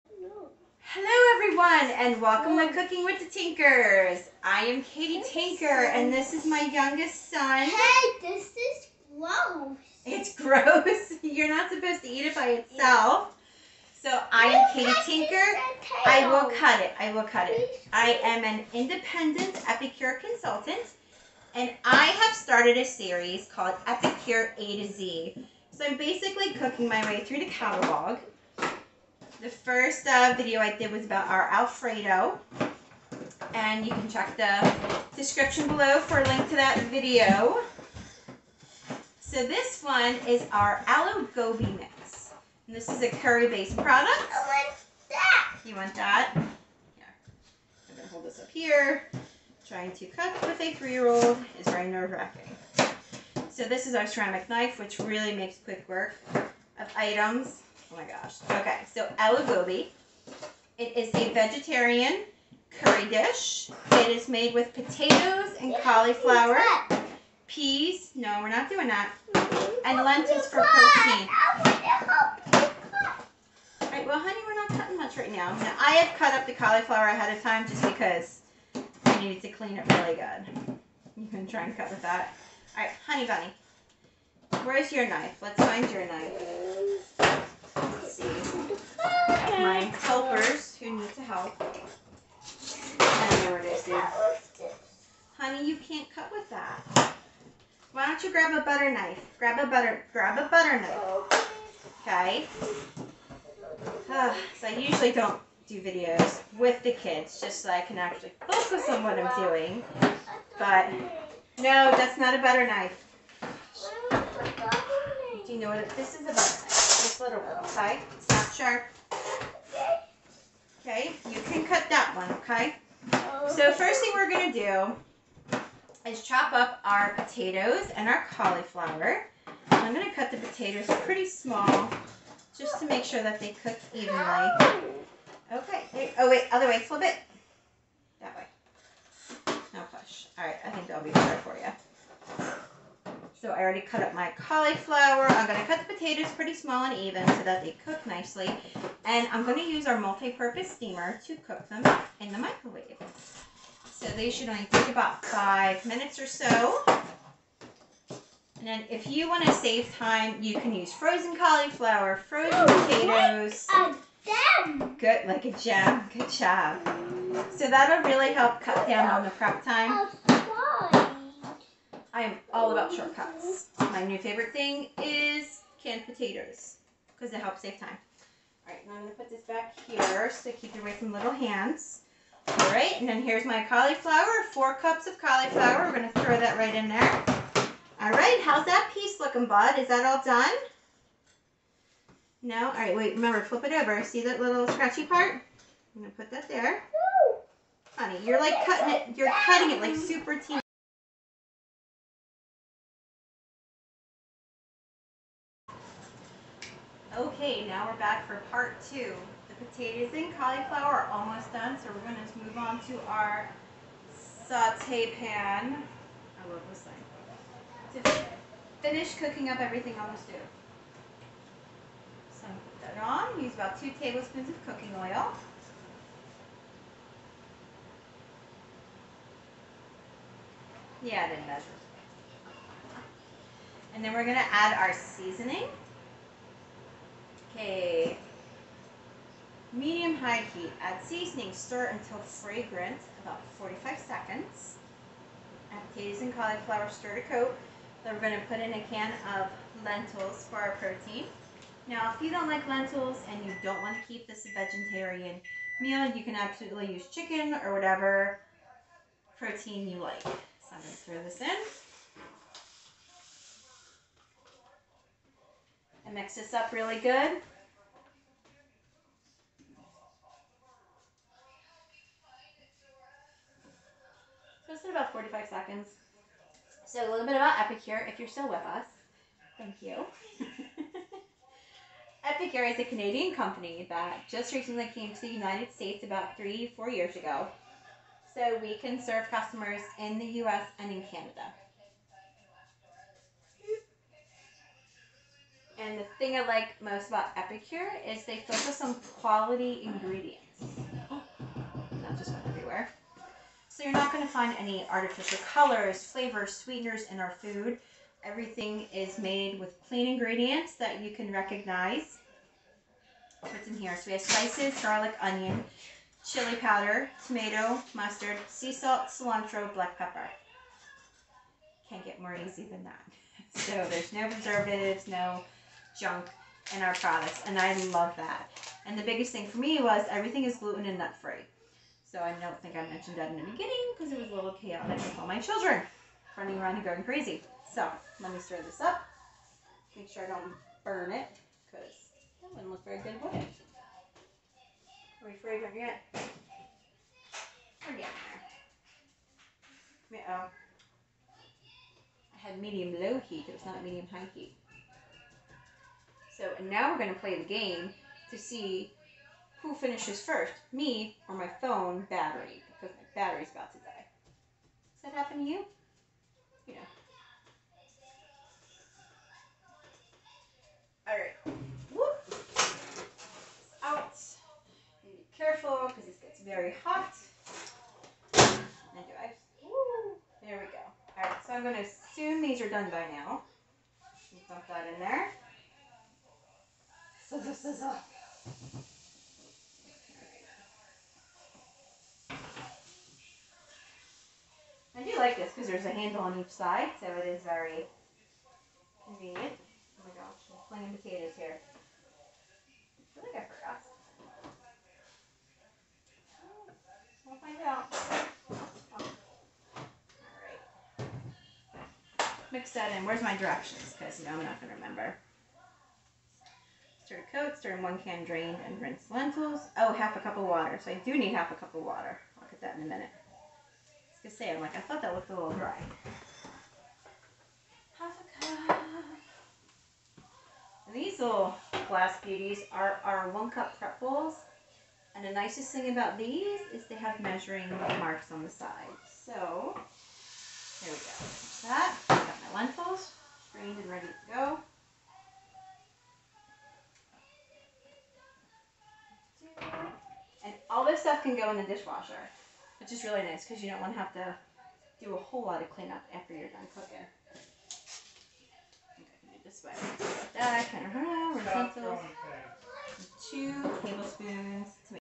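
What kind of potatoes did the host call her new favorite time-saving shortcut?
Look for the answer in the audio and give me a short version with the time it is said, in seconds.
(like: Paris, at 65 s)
Canned potatoes, at 175 s.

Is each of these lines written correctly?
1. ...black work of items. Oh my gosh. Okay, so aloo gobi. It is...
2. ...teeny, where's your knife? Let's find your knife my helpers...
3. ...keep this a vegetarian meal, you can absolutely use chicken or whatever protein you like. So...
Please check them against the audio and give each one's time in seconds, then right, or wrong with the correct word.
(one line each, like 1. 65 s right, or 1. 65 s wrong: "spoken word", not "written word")
1. 55 s wrong: "quick", not "black"
2. 83 s wrong: "bunny", not "teeny"
3. 254 s right.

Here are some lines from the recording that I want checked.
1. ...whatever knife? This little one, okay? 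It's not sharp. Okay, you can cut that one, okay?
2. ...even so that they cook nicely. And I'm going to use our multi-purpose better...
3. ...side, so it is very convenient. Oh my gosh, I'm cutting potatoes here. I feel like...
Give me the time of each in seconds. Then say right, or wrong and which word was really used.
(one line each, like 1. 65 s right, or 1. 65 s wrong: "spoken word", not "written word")
1. 116 s wrong: "butter", not "whatever"
2. 146 s wrong: "steamer", not "better"
3. 396 s wrong: "playing", not "cutting".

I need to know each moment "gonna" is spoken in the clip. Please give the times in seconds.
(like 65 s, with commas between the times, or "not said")
179 s, 185 s, 196 s, 424 s.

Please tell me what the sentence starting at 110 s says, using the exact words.
But no, that's not a butter knife.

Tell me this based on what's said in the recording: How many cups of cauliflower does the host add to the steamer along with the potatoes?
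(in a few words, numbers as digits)
4.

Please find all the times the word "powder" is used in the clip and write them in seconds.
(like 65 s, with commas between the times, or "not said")
316 s.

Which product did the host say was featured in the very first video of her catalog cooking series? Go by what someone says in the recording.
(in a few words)
Alfredo.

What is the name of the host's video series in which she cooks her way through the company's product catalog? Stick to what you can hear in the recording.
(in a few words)
Epicure A to Z.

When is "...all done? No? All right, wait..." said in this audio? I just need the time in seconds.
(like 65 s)
190 s.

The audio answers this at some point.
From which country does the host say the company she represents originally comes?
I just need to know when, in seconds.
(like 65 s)
282 s.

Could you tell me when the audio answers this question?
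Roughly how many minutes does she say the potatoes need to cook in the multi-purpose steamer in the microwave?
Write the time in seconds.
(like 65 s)
155 s.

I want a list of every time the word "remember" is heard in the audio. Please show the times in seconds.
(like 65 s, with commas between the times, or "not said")
193 s, 414 s.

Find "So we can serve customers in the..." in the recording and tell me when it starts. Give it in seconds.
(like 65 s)
288 s.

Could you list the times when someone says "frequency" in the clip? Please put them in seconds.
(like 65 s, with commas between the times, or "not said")
not said.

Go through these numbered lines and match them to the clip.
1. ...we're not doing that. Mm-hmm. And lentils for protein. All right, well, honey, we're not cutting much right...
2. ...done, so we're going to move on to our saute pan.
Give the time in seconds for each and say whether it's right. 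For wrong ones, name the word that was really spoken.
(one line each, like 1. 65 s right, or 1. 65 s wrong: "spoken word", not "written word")
1. 68 s right
2. 211 s right.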